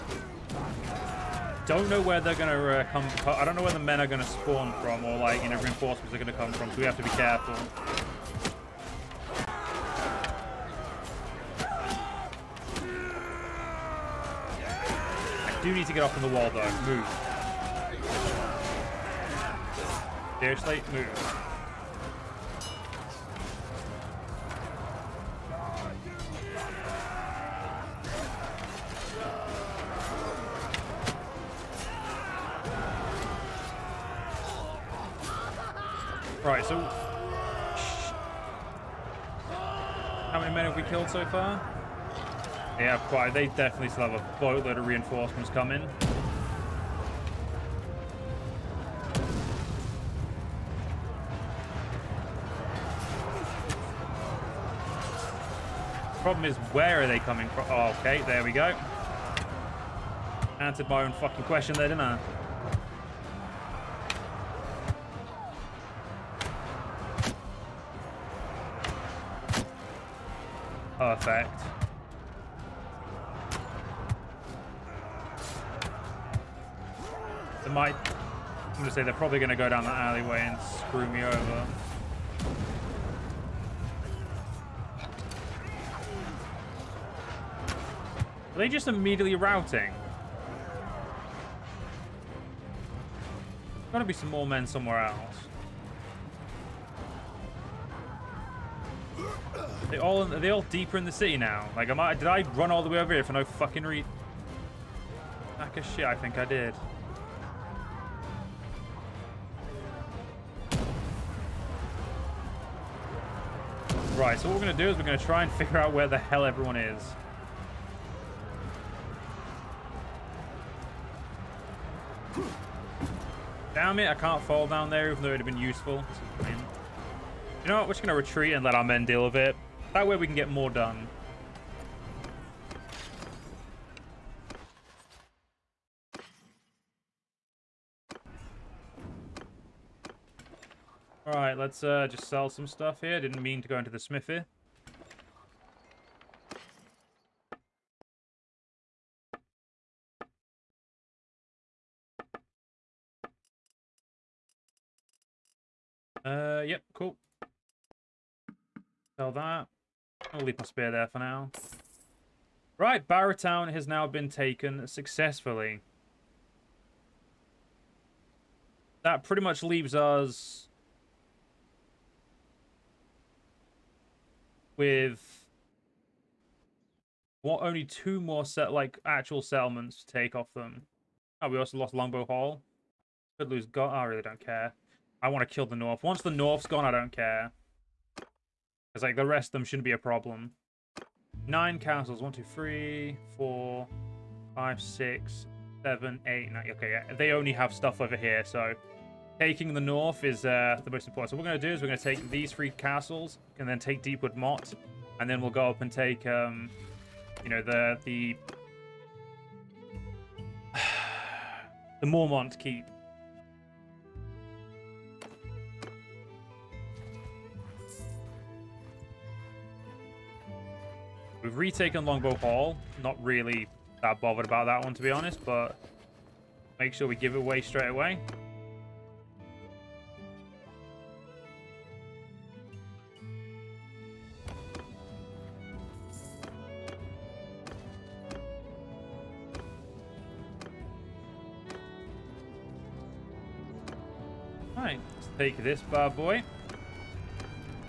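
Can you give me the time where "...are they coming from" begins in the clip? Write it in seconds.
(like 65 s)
57 s.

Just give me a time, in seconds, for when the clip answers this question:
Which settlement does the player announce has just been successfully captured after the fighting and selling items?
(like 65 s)
163 s.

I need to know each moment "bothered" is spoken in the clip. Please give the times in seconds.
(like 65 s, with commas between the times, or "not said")
224 s.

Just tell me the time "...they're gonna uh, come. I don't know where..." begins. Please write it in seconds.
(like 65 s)
2 s.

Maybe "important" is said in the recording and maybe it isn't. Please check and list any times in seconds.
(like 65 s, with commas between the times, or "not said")
201 s.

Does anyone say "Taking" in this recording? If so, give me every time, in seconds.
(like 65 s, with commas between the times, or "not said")
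199 s.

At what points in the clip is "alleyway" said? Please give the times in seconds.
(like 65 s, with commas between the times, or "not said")
79 s.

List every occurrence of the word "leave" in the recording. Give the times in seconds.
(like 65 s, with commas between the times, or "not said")
160 s, 169 s.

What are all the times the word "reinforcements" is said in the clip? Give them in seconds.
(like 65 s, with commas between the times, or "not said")
5 s, 44 s.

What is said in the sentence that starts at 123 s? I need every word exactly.
Damn it, I can't fall down there, even though it would have been useful.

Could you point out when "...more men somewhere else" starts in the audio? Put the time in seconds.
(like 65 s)
94 s.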